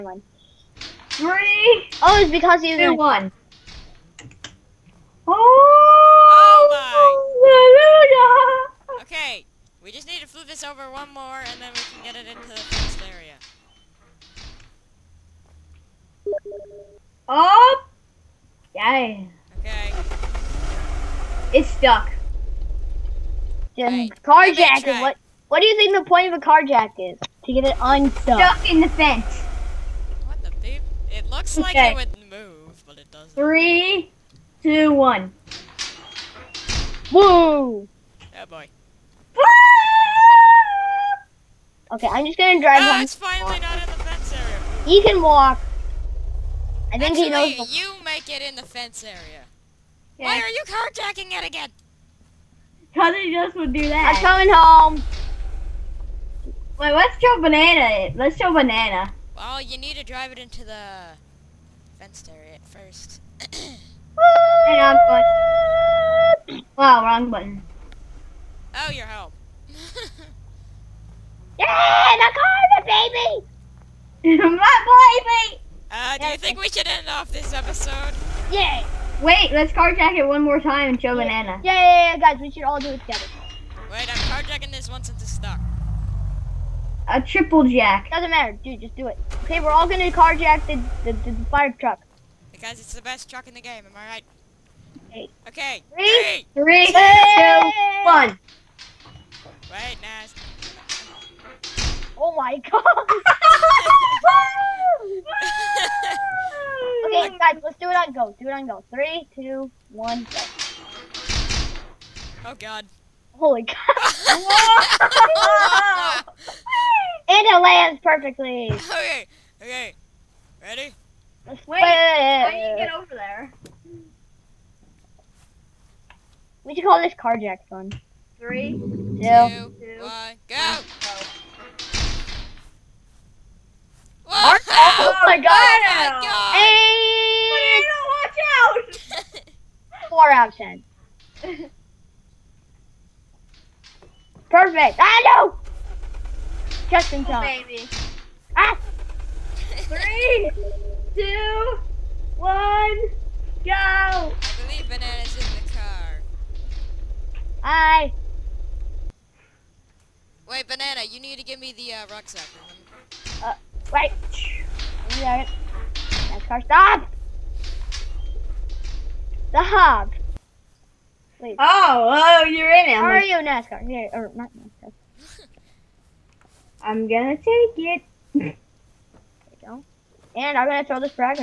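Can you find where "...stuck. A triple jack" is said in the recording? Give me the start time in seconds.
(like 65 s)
85 s.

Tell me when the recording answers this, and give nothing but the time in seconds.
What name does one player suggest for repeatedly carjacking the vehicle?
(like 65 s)
127 s.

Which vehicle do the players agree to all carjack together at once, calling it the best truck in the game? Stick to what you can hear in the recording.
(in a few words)
Fire truck.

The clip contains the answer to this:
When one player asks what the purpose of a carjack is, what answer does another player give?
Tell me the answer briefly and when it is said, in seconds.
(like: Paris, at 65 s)
To get it unstuck, at 27 s.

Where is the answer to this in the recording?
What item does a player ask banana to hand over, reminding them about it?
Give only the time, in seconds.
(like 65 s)
162 s.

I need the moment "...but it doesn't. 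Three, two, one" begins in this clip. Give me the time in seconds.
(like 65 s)
32 s.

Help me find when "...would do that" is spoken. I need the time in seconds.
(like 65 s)
53 s.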